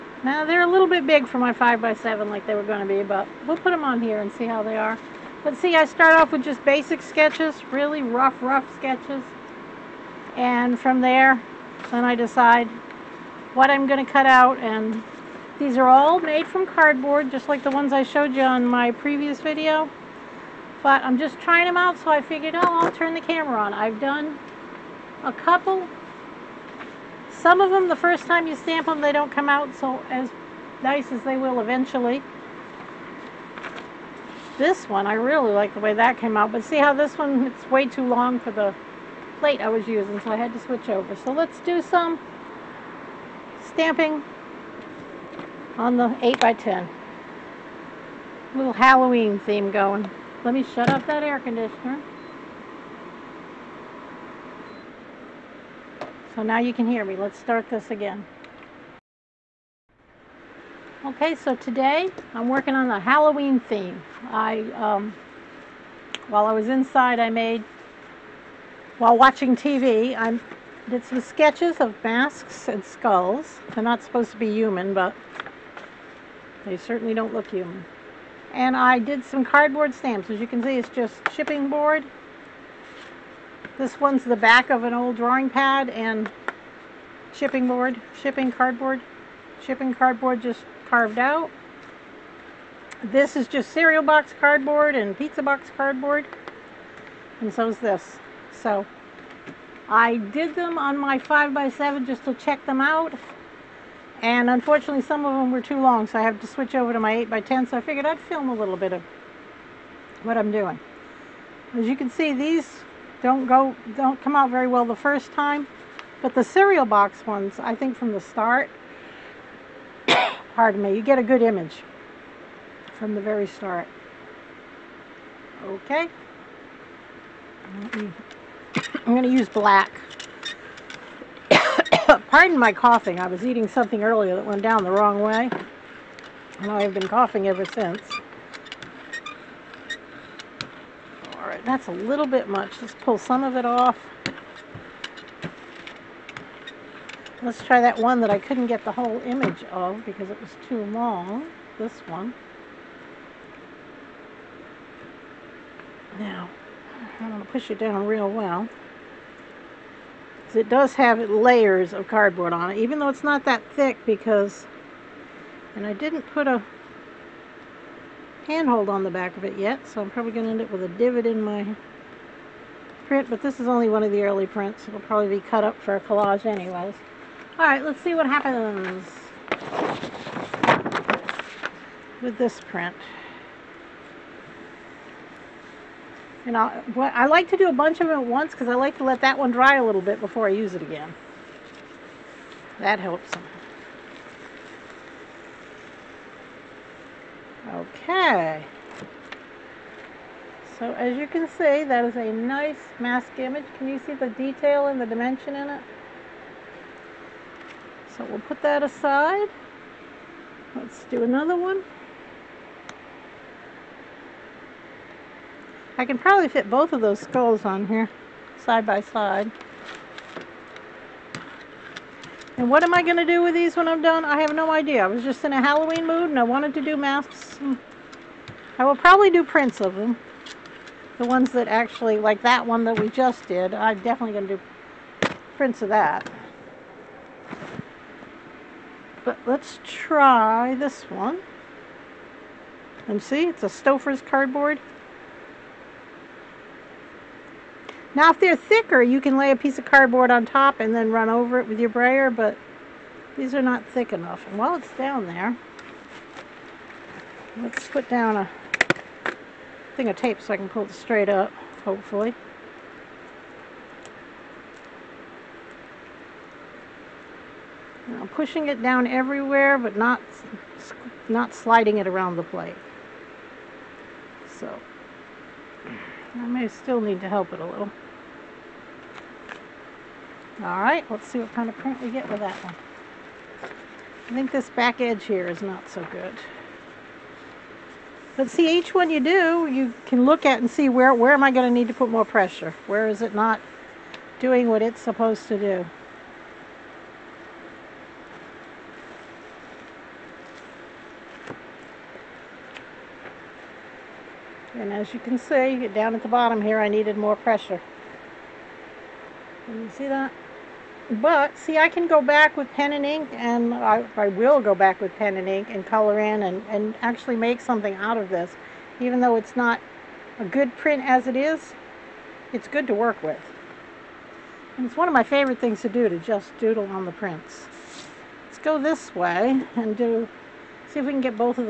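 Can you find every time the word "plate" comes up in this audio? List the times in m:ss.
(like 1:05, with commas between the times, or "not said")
0:39, 4:32.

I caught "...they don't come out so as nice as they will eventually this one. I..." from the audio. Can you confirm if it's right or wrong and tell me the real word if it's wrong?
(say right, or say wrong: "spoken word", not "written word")
right.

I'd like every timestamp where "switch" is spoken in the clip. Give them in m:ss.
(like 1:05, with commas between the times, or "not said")
0:40, 1:46.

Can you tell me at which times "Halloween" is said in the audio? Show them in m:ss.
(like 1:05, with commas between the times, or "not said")
0:48, 1:02, 3:45.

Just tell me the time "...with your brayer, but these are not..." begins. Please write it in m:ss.
4:11.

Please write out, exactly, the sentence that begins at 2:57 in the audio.
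Alright, let's see what happens with this print.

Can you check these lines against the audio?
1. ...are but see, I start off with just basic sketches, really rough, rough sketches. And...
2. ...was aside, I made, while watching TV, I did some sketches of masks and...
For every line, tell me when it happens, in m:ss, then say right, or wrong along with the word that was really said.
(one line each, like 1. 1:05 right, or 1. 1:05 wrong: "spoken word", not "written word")
1. 0:04 right
2. 1:06 wrong: "inside", not "aside".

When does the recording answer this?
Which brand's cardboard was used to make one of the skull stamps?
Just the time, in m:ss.
4:03.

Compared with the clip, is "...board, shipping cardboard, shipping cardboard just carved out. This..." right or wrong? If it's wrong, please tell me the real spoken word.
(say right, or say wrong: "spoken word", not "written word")
right.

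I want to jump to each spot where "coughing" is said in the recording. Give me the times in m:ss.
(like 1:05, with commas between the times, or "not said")
2:12, 2:17.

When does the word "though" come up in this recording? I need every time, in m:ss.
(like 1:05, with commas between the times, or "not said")
2:42, 5:19.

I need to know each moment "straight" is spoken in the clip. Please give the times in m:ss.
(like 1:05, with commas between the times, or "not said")
4:20.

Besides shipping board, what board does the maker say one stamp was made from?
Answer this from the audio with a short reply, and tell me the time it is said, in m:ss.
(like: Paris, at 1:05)
back of an old drawing pad, at 1:24.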